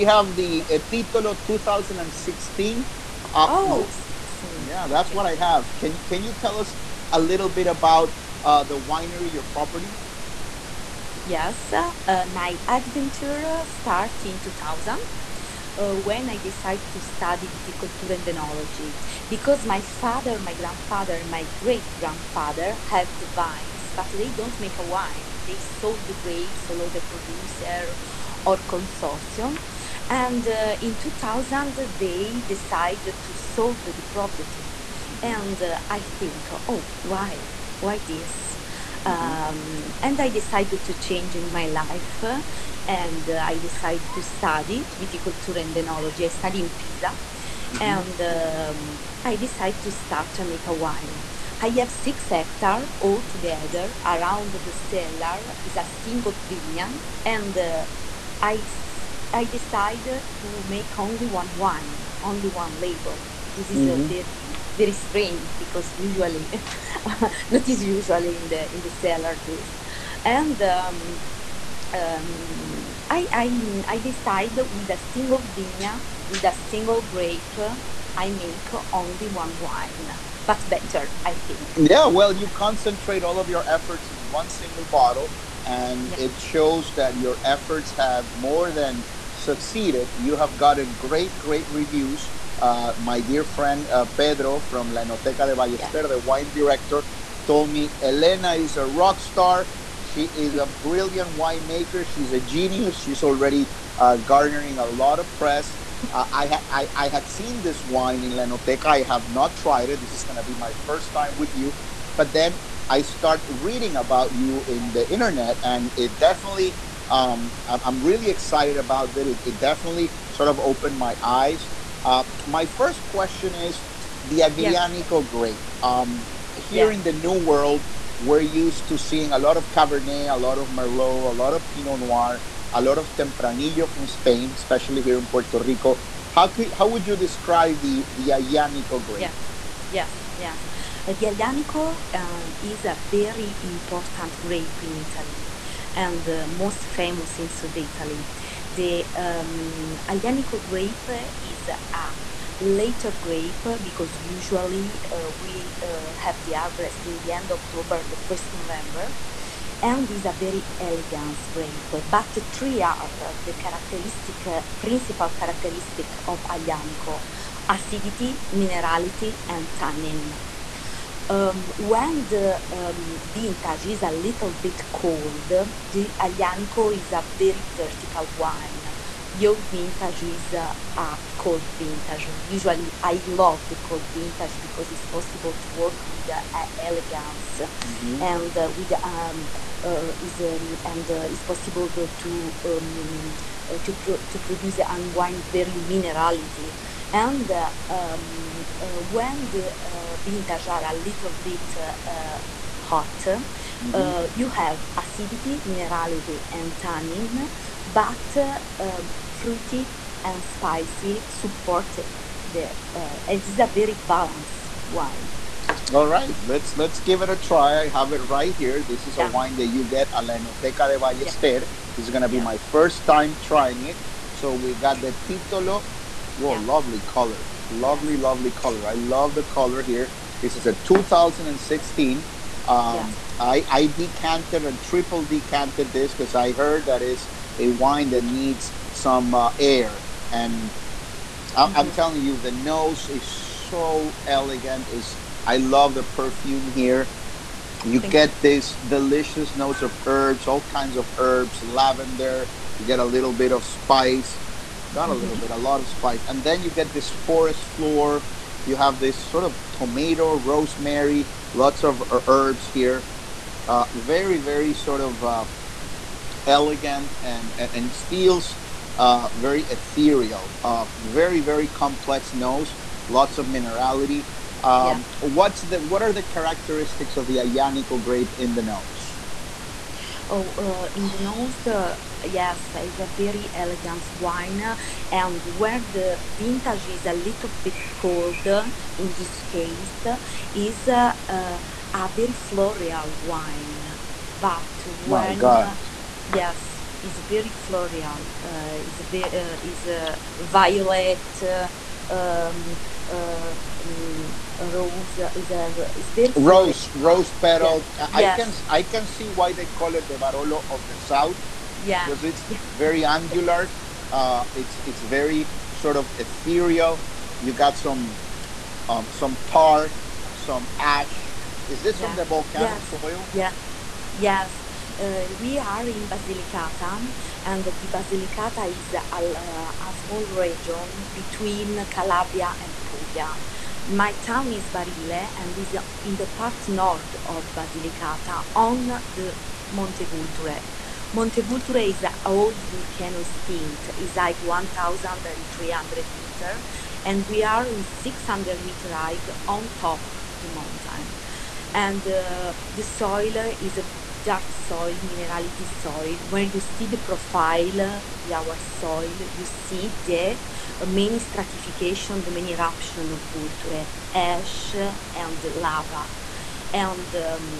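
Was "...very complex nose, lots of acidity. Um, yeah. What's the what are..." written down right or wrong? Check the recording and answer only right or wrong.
wrong.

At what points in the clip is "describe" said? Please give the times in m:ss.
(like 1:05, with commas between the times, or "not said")
2:17.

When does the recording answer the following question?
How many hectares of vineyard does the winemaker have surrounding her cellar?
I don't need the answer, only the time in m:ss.
0:51.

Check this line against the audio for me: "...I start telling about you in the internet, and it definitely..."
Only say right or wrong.
wrong.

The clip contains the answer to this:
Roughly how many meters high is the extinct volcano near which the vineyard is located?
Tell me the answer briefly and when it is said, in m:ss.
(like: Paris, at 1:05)
1,300, at 5:44.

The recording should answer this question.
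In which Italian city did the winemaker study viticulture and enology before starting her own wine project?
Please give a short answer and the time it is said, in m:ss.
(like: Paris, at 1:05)
Pisa, at 0:46.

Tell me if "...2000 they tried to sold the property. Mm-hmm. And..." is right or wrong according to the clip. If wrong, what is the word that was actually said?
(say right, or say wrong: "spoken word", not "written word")
wrong: "decided", not "tried".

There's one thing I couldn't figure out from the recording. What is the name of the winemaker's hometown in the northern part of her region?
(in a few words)
Barile.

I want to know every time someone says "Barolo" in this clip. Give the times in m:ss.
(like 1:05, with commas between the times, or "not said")
5:10.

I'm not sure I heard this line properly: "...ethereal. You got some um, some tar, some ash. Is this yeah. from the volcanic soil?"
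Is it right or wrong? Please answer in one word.
right.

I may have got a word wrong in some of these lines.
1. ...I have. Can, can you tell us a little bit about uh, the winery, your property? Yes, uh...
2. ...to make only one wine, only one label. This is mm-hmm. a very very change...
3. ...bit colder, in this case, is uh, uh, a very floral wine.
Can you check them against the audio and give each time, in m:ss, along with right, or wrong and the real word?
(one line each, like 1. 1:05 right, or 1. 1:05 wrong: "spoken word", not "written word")
1. 0:05 right
2. 1:00 wrong: "strange", not "change"
3. 4:47 right.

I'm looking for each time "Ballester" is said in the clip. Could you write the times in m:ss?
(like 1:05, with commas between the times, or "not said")
1:35, 3:40.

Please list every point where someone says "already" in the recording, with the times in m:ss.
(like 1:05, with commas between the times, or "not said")
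1:43.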